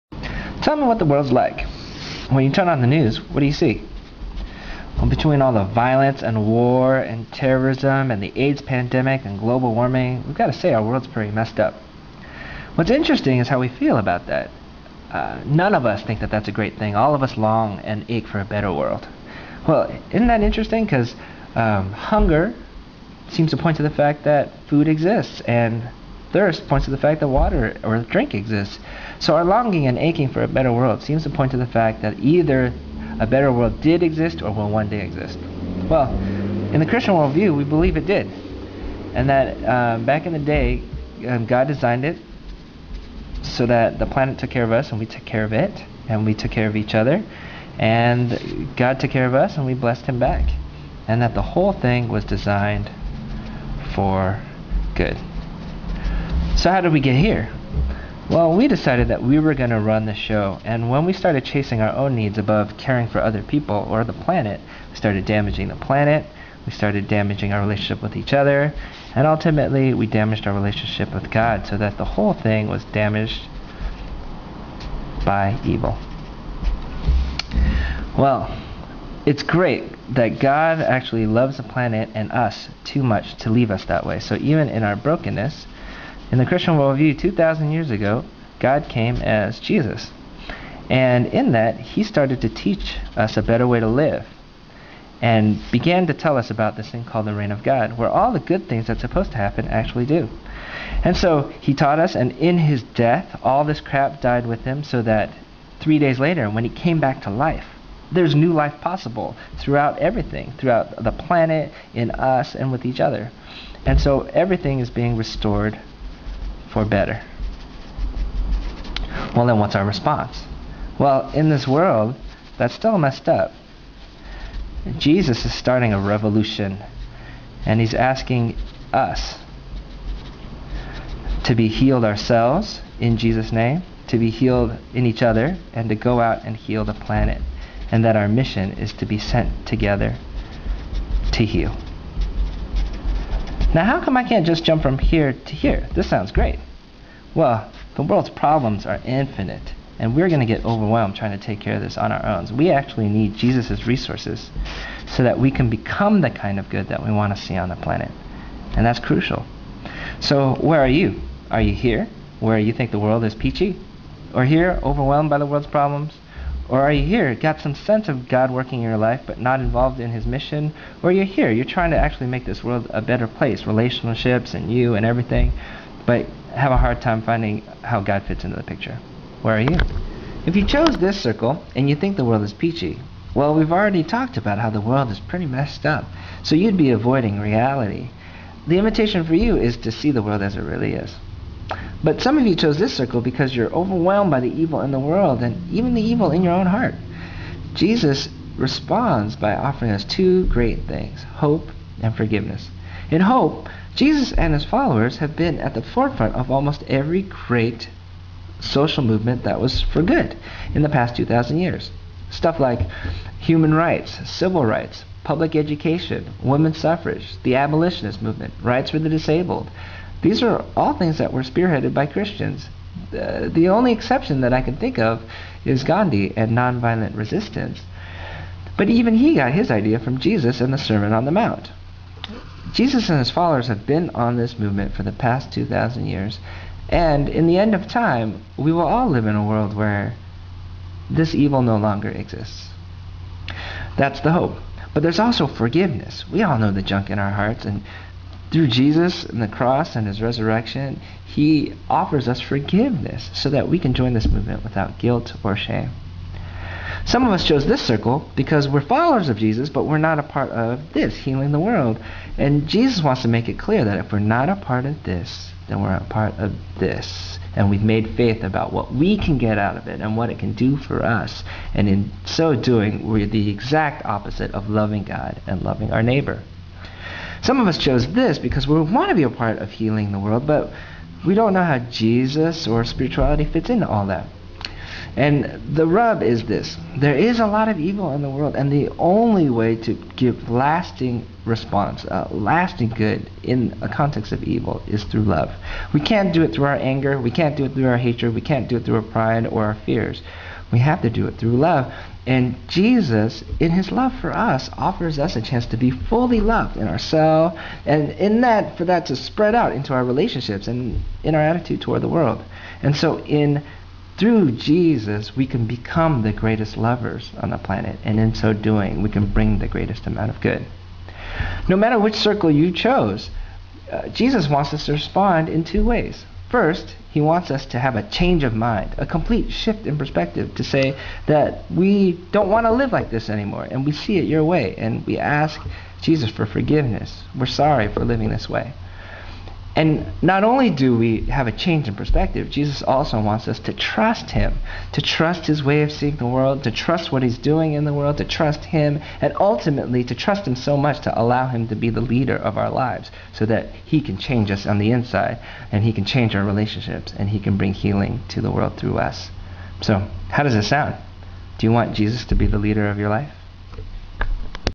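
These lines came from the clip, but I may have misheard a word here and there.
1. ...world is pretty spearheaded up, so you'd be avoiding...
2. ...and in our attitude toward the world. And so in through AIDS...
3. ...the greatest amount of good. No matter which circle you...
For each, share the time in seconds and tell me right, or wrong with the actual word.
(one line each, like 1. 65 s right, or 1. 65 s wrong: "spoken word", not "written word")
1. 184 s wrong: "messed", not "spearheaded"
2. 310 s wrong: "Jesus", not "AIDS"
3. 319 s right.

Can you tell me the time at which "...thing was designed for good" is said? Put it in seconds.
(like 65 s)
51 s.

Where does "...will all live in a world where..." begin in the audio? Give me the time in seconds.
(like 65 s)
238 s.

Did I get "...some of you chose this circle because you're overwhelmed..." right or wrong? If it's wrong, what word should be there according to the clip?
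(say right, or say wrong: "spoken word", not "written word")
right.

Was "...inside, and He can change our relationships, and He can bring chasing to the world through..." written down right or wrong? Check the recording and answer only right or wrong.
wrong.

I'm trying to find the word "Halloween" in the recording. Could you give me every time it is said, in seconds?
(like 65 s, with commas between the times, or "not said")
not said.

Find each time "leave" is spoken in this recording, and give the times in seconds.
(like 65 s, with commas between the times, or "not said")
83 s.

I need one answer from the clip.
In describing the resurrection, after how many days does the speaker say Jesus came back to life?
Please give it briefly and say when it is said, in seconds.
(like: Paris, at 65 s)
3 days, at 105 s.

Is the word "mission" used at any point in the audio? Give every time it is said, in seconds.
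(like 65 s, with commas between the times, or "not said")
138 s, 170 s.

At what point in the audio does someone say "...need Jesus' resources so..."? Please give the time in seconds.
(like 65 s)
153 s.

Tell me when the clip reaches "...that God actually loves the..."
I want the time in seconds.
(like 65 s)
80 s.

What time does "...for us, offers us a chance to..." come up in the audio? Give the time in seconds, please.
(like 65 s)
304 s.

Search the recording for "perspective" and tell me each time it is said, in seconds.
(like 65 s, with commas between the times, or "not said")
329 s, 341 s.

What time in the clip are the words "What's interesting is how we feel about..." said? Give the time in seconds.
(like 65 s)
12 s.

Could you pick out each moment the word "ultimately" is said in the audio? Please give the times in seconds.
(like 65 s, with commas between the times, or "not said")
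69 s, 349 s.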